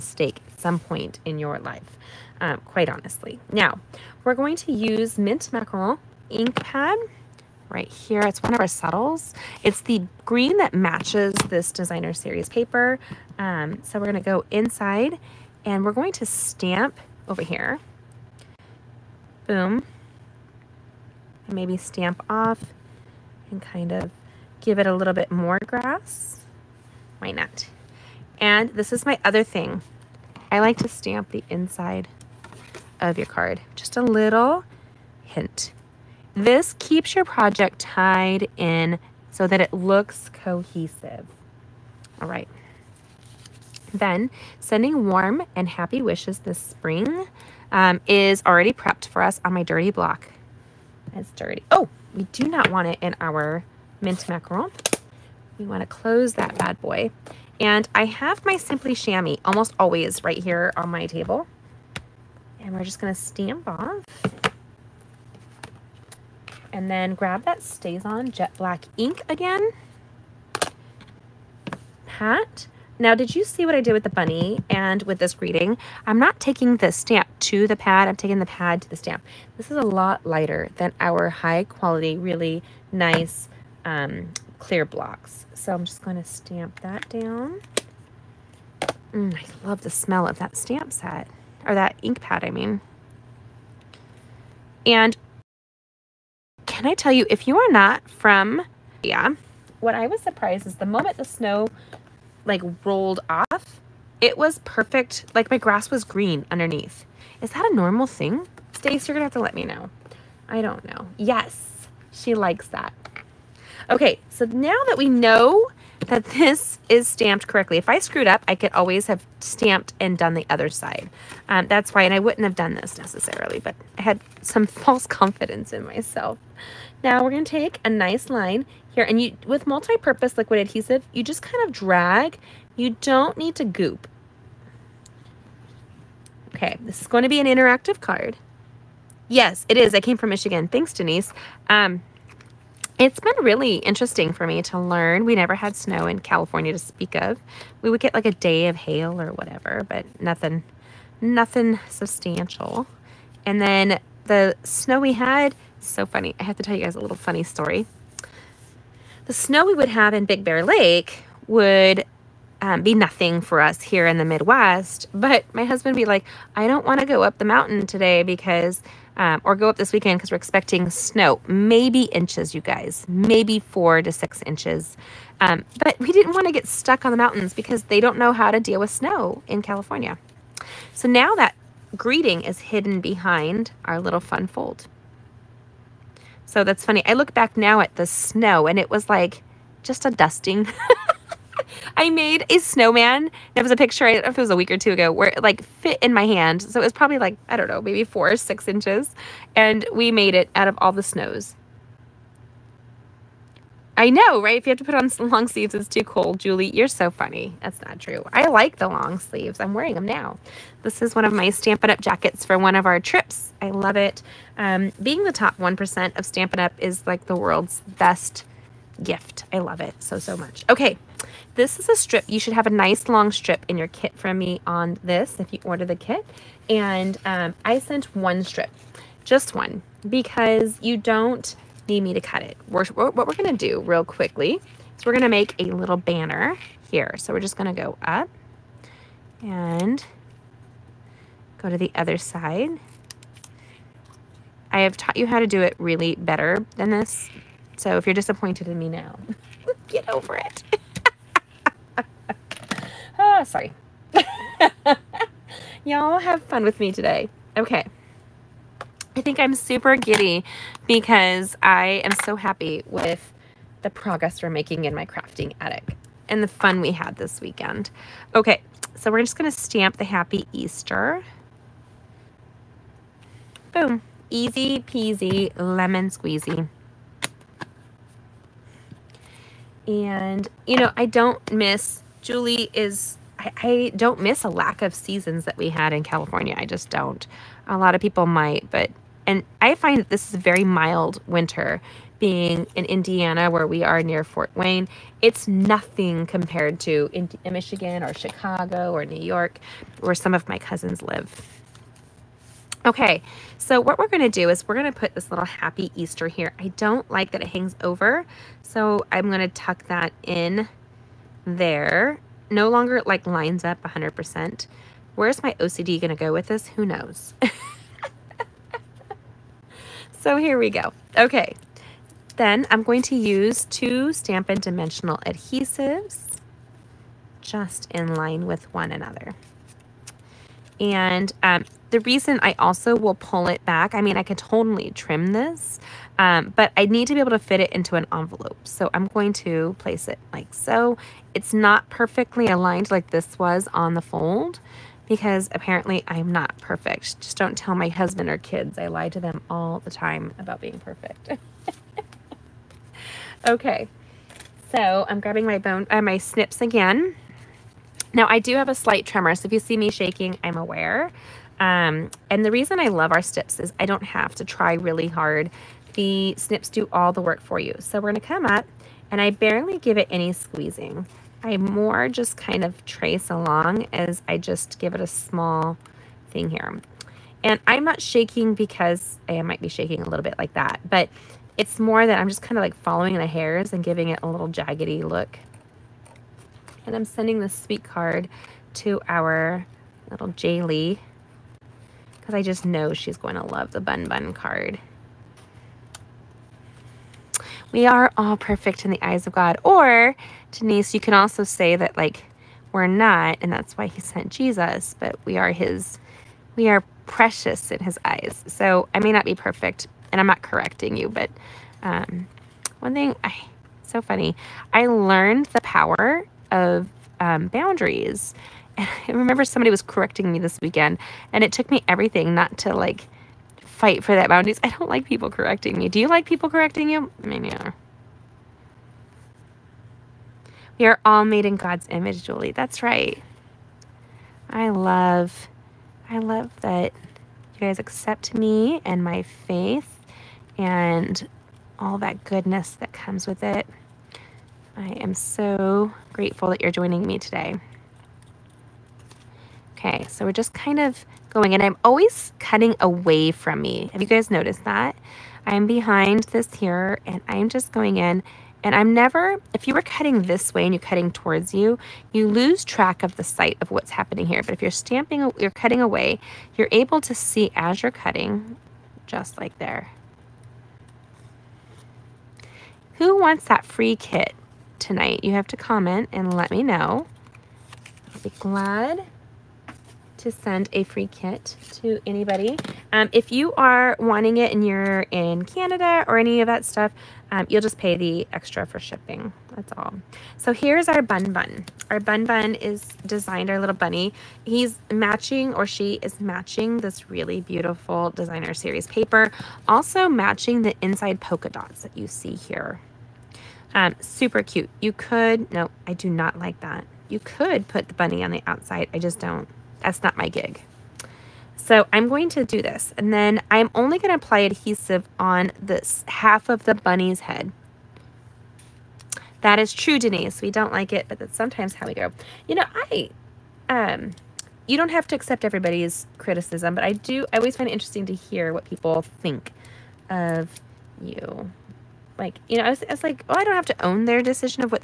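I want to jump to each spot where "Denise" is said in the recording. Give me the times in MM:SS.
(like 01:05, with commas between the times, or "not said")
02:20, 06:40, 08:39.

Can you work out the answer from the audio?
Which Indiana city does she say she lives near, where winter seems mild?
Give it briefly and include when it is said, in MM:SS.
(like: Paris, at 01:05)
Fort Wayne, at 04:54.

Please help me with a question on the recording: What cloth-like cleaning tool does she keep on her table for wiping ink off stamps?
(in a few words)
Simply Shammy.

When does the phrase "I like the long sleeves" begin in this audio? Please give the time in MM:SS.
03:28.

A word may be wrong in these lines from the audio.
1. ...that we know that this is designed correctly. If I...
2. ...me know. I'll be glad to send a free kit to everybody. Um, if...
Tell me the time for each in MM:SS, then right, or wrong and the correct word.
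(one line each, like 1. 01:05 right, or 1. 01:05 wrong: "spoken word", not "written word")
1. 01:54 wrong: "stamped", not "designed"
2. 07:56 wrong: "anybody", not "everybody".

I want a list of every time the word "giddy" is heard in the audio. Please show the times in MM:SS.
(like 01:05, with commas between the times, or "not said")
04:19.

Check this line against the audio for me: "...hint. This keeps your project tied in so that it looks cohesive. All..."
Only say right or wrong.
right.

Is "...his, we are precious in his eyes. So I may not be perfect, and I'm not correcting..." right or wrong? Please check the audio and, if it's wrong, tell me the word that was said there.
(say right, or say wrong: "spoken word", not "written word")
right.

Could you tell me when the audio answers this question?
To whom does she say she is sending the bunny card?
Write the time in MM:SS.
06:30.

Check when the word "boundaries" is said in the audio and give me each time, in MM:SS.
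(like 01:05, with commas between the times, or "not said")
06:57, 07:04.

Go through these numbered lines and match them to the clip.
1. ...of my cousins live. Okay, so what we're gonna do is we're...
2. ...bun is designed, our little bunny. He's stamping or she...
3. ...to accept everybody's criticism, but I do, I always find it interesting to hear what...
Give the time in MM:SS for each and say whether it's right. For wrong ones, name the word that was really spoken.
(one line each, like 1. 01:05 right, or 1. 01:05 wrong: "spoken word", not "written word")
1. 05:00 right
2. 08:12 wrong: "matching", not "stamping"
3. 08:45 right.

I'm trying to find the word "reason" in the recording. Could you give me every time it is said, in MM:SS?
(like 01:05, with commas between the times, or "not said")
05:31, 06:02.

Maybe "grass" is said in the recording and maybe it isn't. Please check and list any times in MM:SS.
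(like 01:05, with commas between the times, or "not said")
00:25, 01:45.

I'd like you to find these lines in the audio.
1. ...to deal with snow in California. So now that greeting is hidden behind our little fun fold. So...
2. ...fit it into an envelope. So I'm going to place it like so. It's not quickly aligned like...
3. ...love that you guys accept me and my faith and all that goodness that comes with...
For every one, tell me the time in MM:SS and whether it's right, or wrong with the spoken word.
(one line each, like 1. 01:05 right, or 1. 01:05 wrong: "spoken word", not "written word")
1. 02:58 right
2. 05:37 wrong: "perfectly", not "quickly"
3. 07:16 right.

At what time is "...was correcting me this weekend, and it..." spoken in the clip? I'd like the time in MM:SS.
06:59.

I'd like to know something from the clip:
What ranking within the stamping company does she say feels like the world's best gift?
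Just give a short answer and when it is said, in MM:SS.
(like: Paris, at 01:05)
top 1%, at 03:35.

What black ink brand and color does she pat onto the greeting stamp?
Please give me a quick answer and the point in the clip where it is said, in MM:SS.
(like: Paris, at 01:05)
StazOn Jet Black, at 01:07.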